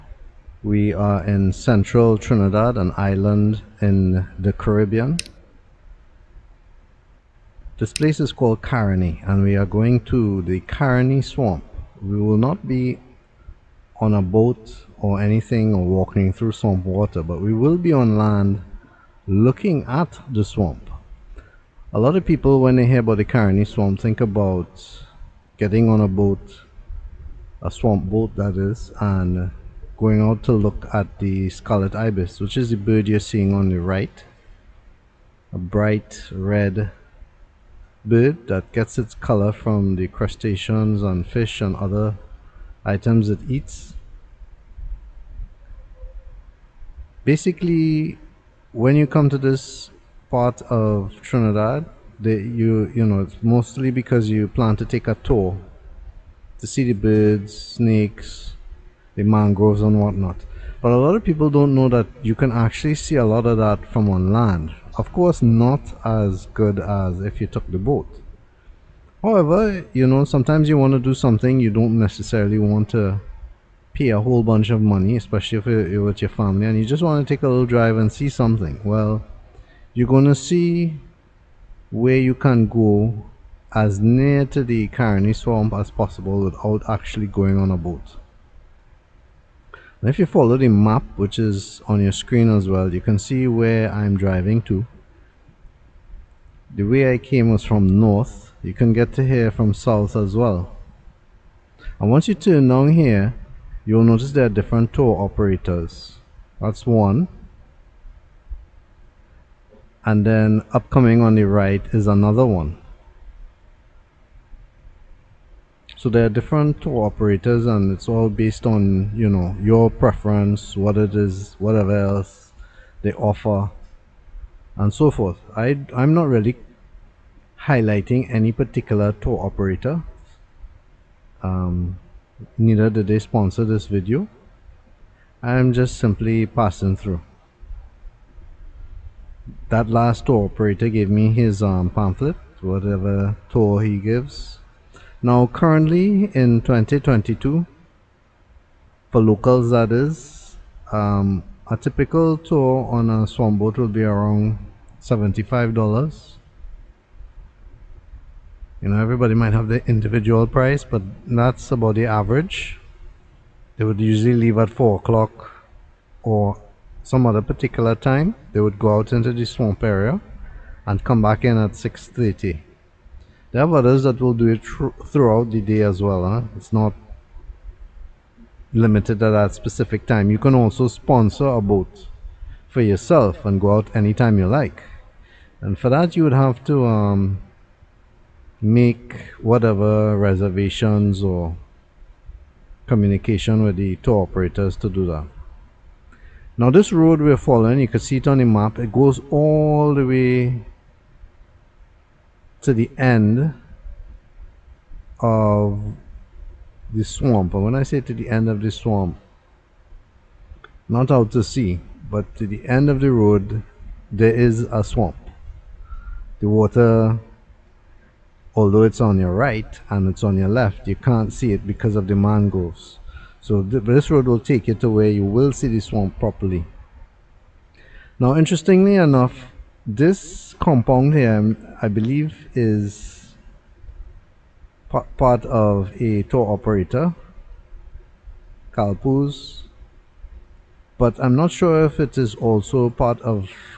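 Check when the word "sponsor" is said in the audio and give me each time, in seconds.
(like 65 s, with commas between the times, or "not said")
133 s, 180 s.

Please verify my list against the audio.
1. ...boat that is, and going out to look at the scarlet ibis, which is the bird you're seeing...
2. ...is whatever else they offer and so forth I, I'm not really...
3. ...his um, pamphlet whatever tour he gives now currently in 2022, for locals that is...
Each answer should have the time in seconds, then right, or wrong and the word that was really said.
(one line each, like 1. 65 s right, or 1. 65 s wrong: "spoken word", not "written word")
1. 28 s right
2. 121 s right
3. 141 s right.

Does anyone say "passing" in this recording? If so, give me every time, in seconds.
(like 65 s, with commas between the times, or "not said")
136 s.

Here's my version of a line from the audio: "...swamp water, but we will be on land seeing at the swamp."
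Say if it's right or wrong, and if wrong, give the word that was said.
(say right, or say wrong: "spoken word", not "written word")
wrong: "looking", not "seeing".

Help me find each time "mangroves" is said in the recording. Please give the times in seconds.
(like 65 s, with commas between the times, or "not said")
59 s, 222 s.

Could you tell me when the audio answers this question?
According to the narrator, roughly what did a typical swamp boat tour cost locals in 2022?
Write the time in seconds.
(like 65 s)
155 s.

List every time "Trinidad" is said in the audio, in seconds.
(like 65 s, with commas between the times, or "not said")
2 s, 51 s.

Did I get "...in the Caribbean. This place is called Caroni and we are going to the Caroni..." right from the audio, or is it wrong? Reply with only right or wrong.
right.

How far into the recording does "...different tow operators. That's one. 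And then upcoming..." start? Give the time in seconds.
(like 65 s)
104 s.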